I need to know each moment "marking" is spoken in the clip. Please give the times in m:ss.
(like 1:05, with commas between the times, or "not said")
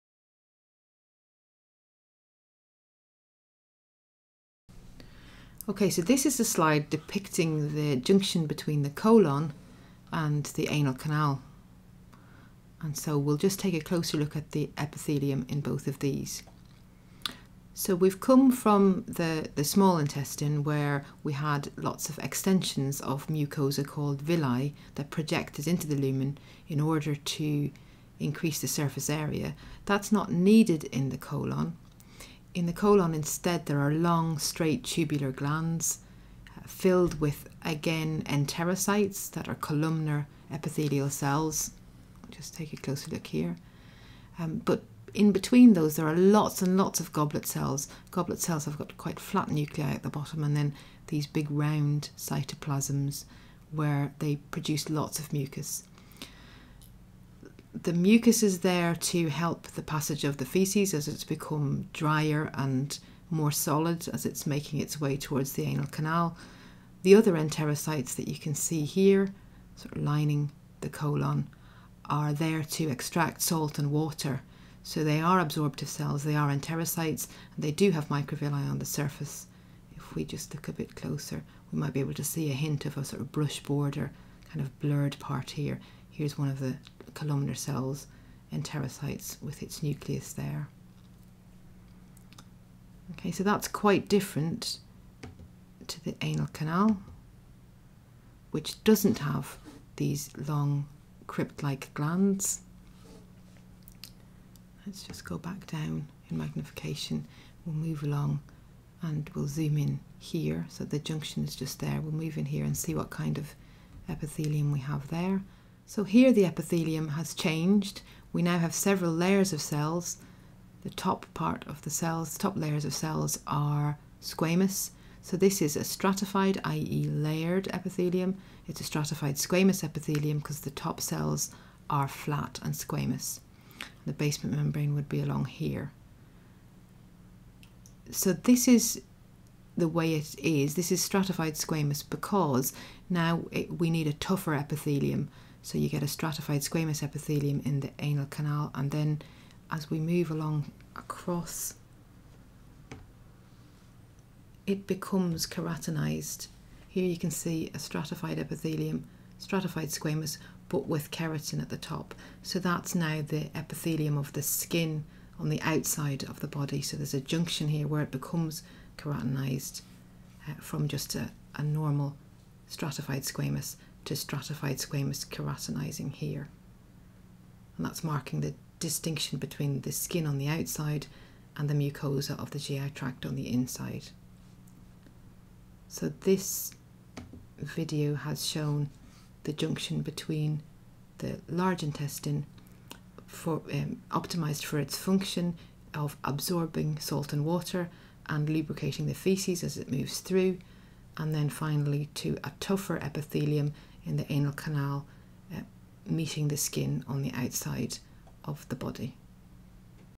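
2:58.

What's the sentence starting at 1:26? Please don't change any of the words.
Here's one of the columnar cells and enterocytes with its nucleus there.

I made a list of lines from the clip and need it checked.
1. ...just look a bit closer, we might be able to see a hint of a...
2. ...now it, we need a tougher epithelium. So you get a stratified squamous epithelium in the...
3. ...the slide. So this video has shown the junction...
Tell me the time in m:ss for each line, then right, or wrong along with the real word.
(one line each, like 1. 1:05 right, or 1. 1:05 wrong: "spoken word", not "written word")
1. 1:20 right
2. 2:23 right
3. 3:03 wrong: "inside", not "slide".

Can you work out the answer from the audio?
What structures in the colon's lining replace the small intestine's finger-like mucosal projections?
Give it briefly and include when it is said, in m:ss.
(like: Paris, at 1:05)
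long, straight tubular glands, at 0:33.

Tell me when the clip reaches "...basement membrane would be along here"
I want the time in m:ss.
2:14.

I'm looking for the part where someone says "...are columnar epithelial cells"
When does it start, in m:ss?
0:39.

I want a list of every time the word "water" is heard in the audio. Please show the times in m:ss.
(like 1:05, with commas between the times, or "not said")
1:13, 3:17.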